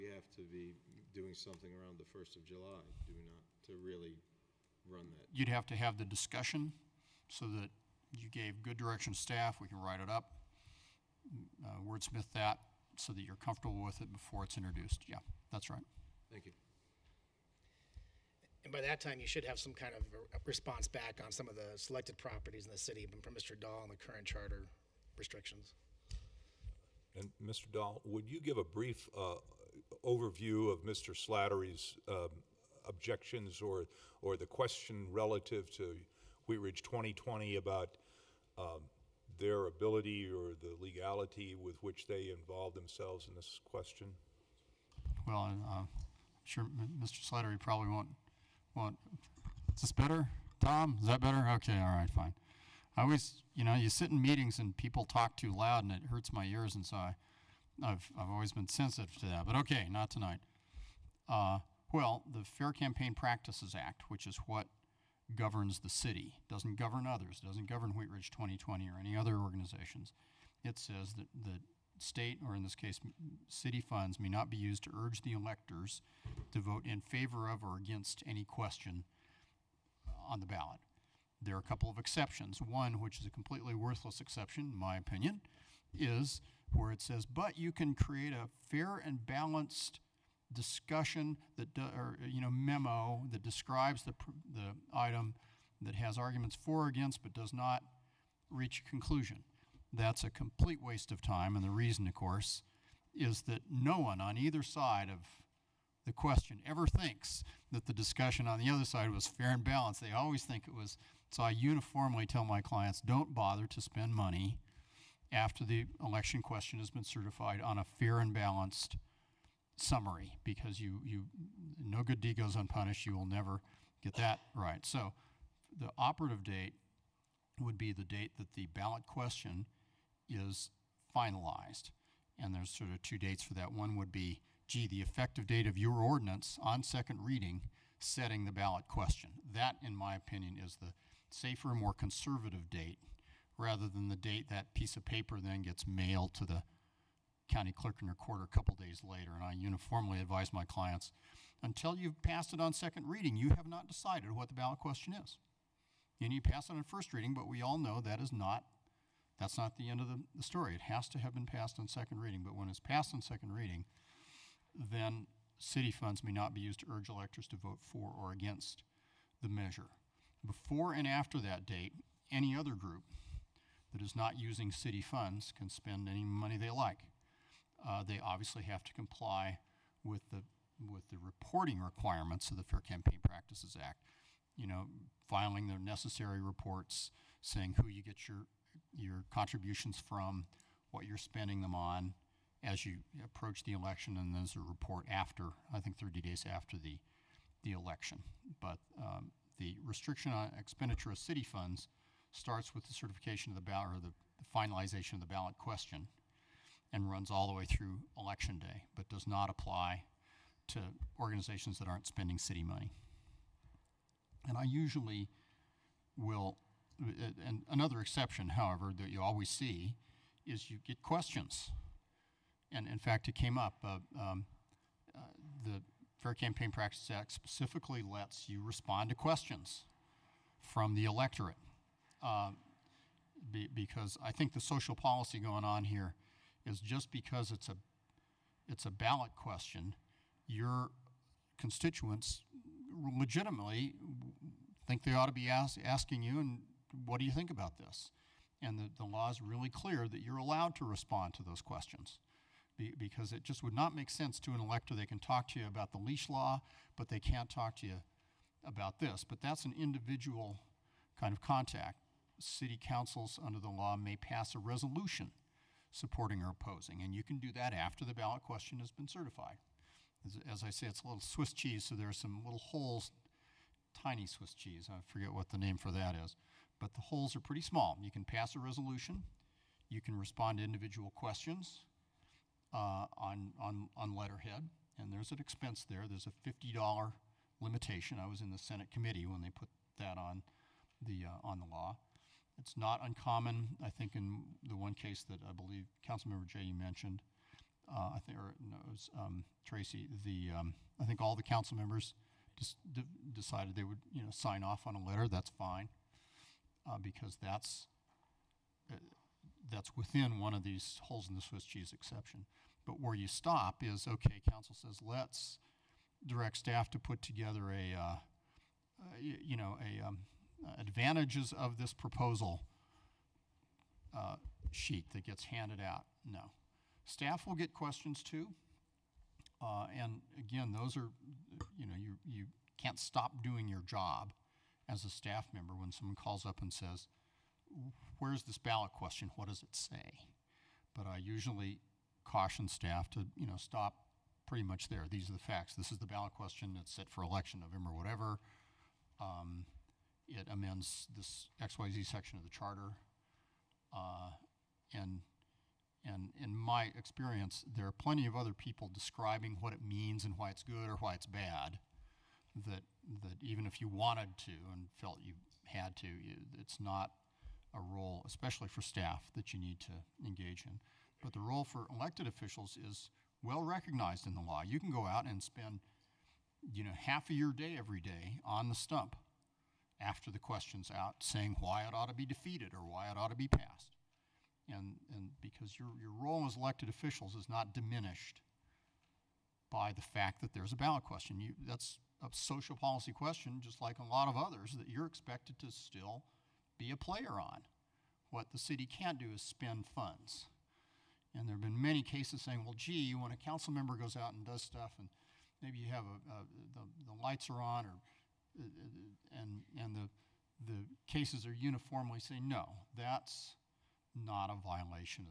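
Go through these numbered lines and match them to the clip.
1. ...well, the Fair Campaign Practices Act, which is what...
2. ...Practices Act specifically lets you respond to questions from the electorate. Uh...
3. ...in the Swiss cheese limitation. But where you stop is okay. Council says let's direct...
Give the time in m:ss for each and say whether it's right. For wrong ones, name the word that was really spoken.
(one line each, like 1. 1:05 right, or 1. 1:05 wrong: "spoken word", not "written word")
1. 1:01 right
2. 3:46 right
3. 5:11 wrong: "exception", not "limitation".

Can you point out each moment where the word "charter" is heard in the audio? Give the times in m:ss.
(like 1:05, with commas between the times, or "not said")
0:24, 5:52.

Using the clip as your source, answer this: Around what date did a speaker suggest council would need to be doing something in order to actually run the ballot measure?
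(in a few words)
1st of July.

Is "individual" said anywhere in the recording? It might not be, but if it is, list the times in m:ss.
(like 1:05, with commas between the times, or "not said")
4:19, 4:40.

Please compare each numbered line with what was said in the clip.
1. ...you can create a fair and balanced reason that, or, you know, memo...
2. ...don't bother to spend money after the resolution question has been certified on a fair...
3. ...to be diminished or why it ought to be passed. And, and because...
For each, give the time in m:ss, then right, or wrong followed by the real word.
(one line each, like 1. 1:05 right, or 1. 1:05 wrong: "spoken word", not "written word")
1. 1:27 wrong: "discussion", not "reason"
2. 1:52 wrong: "election", not "resolution"
3. 6:22 wrong: "defeated", not "diminished".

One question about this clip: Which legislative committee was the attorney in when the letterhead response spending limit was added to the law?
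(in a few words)
Senate committee.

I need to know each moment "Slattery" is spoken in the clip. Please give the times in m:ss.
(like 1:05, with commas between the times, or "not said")
0:31, 0:47.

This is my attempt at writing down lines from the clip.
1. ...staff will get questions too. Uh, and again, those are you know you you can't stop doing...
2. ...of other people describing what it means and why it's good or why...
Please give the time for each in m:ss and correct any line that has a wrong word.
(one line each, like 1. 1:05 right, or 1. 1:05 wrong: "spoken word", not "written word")
1. 5:27 right
2. 5:58 right.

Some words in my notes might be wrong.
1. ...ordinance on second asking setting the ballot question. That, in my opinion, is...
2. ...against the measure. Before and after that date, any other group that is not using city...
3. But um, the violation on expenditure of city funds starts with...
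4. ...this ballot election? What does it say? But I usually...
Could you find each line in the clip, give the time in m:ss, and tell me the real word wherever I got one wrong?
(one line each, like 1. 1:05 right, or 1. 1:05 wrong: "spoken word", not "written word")
1. 2:15 wrong: "reading", not "asking"
2. 2:48 right
3. 3:18 wrong: "restriction", not "violation"
4. 5:38 wrong: "question", not "election".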